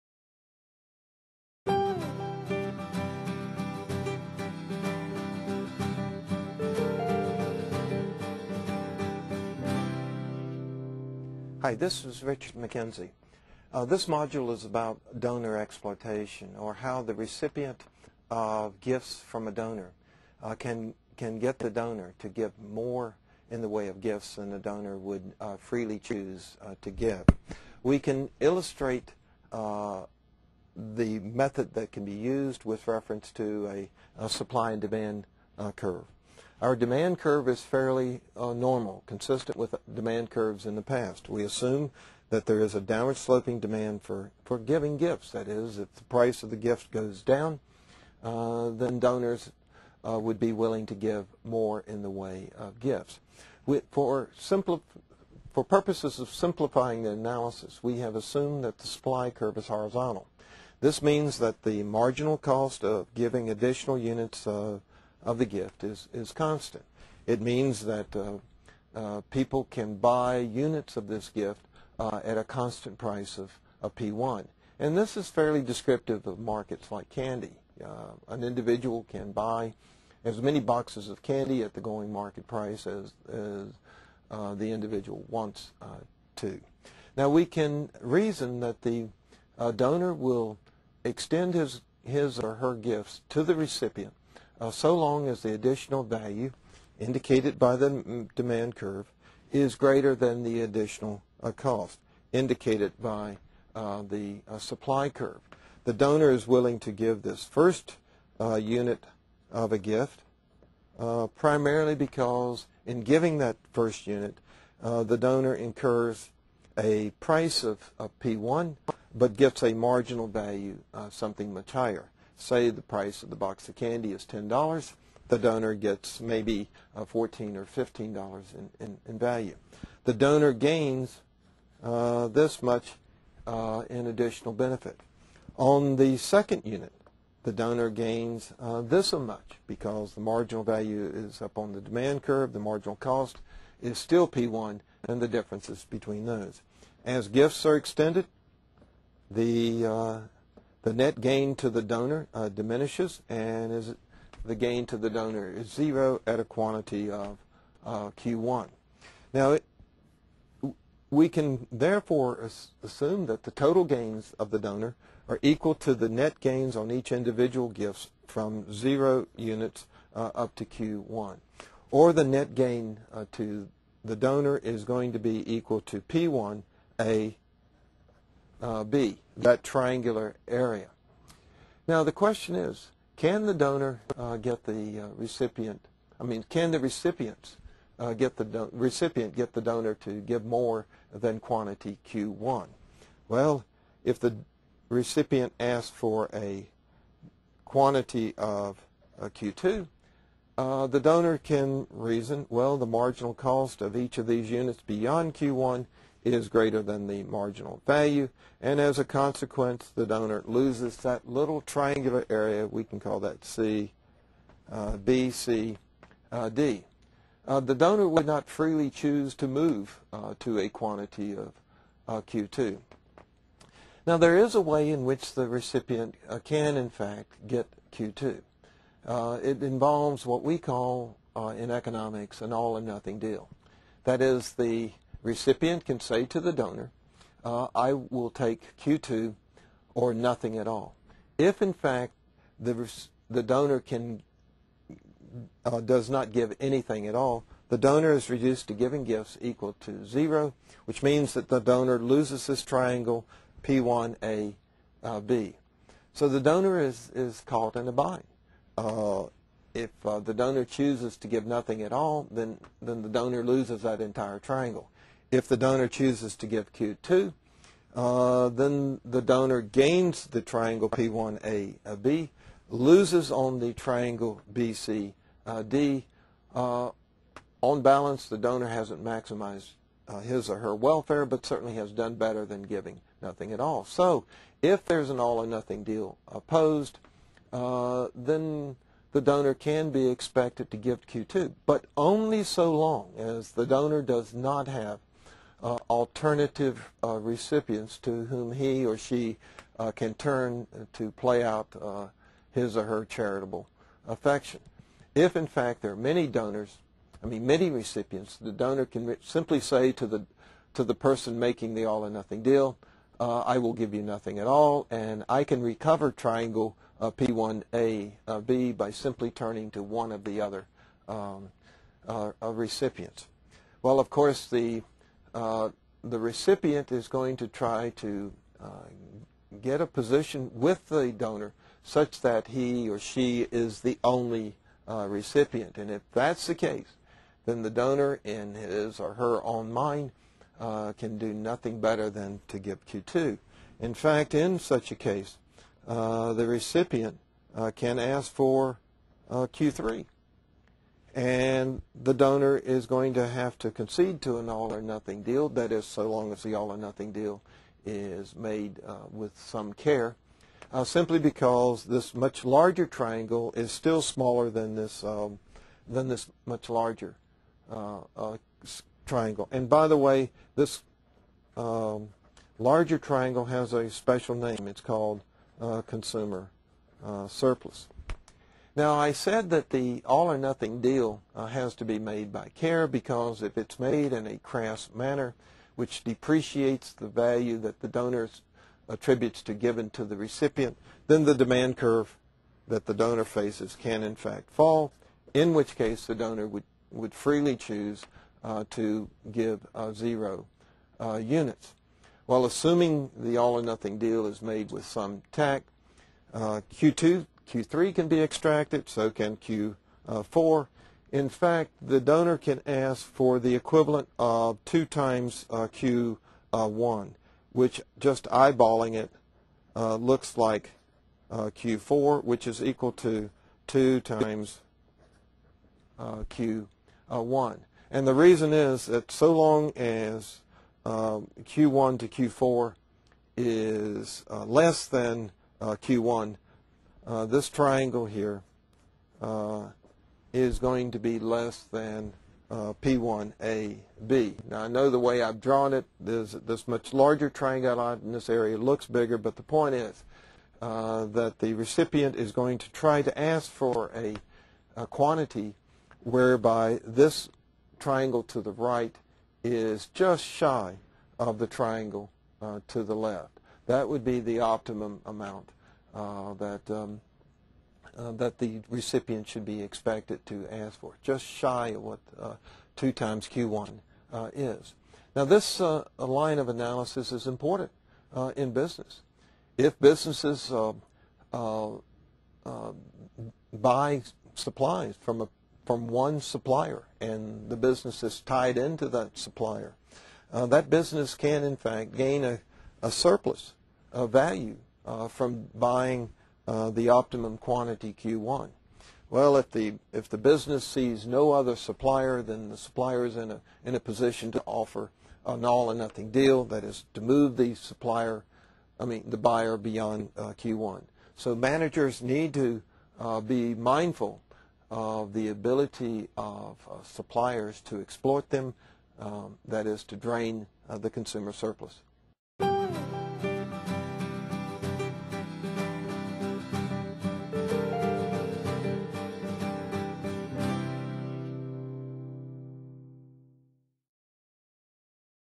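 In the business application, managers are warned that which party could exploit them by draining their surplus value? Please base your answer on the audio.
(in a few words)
suppliers.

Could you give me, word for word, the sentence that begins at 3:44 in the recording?
Now, there is a way in which the recipient uh, can, in fact, get Q2.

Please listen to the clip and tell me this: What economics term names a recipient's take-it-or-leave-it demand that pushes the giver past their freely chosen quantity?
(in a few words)
all-or-nothing deal.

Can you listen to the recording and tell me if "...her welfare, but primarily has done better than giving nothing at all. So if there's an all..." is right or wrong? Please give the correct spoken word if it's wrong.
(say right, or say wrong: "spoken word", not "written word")
wrong: "certainly", not "primarily".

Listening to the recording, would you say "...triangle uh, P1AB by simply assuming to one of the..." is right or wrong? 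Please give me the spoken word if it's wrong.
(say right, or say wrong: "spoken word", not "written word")
wrong: "turning", not "assuming".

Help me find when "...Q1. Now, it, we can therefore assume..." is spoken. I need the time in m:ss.
2:38.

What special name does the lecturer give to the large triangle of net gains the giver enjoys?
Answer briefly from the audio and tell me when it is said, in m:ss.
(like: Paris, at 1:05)
consumer surplus, at 6:15.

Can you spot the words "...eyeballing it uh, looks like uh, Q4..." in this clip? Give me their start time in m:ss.
6:58.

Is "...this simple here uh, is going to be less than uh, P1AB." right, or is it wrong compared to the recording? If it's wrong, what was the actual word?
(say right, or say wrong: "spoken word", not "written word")
wrong: "triangle", not "simple".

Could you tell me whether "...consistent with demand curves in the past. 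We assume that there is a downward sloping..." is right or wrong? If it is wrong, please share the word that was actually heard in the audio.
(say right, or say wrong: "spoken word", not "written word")
right.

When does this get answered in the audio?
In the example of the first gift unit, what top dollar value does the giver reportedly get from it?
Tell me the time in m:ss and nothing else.
2:07.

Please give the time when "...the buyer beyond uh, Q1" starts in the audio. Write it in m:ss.
8:29.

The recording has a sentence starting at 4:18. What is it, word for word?
Uh, if uh, the donor chooses to give nothing at all, then, then the donor loses that entire triangle.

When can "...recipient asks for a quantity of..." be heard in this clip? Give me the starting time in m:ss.
3:14.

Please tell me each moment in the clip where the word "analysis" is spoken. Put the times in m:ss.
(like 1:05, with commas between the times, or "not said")
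0:57, 7:56.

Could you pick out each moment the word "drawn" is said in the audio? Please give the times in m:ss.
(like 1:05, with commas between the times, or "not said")
7:25.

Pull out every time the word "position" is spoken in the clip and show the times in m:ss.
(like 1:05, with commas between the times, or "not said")
5:29, 8:23.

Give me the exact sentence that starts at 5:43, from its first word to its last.
In fact, in such a case, uh, the recipient uh, can ask for uh, Q3.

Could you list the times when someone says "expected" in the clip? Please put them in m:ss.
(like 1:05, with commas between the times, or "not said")
4:50, 7:49.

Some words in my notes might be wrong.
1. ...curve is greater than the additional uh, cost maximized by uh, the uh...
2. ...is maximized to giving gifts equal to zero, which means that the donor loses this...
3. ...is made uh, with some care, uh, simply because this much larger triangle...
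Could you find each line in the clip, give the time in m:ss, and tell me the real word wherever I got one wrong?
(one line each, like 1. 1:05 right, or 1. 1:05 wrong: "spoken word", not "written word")
1. 1:38 wrong: "indicated", not "maximized"
2. 4:08 wrong: "reduced", not "maximized"
3. 5:57 right.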